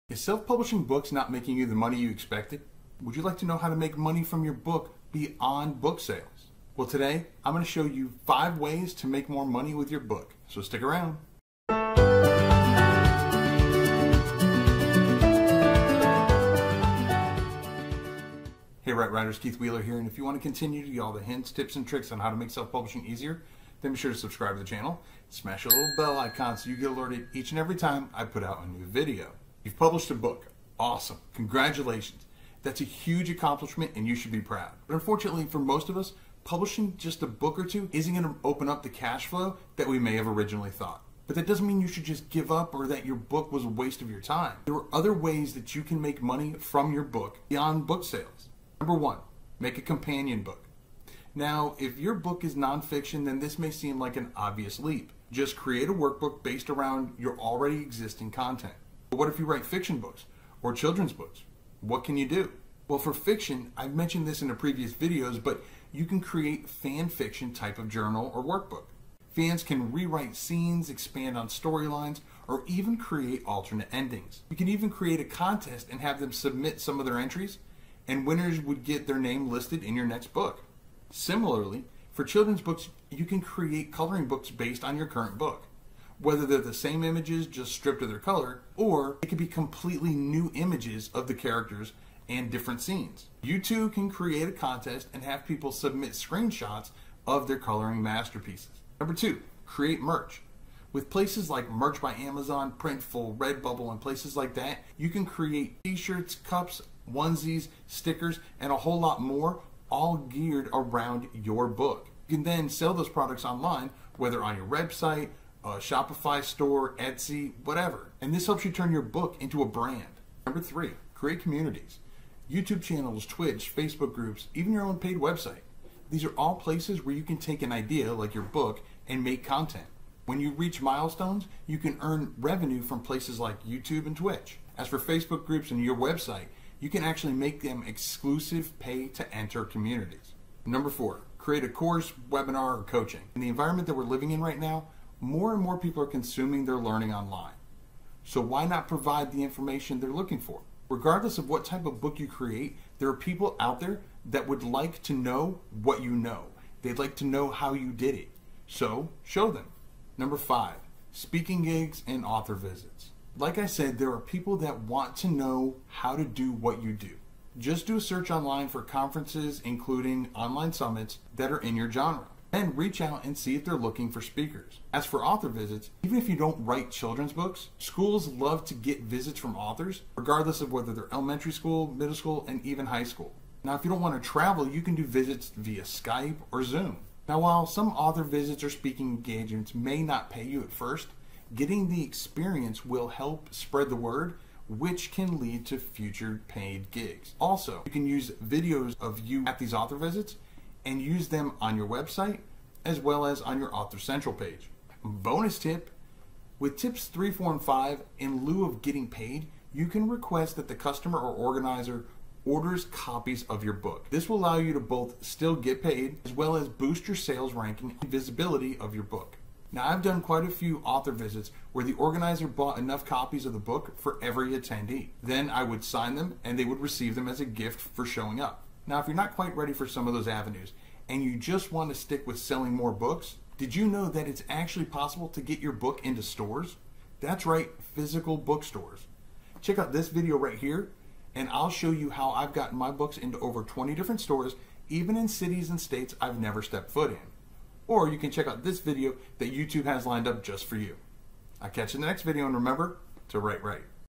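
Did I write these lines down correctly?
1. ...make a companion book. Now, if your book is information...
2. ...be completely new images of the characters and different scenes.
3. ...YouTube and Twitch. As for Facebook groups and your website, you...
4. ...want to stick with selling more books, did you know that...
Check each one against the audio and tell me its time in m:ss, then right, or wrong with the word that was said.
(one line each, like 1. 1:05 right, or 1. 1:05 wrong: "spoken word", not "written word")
1. 0:49 wrong: "nonfiction", not "information"
2. 1:29 right
3. 2:13 right
4. 3:51 right.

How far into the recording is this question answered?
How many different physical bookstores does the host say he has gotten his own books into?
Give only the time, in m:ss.
4:03.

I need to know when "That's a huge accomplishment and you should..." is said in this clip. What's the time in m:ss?
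0:32.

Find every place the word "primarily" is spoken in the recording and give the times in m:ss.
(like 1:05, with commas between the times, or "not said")
not said.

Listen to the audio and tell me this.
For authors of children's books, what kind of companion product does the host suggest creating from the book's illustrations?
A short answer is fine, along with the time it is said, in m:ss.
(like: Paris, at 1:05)
Coloring books, at 1:23.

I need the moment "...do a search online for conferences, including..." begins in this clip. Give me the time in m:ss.
2:47.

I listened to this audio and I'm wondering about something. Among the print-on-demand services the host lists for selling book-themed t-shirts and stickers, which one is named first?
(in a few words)
Merch by Amazon.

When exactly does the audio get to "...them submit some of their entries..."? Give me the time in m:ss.
1:16.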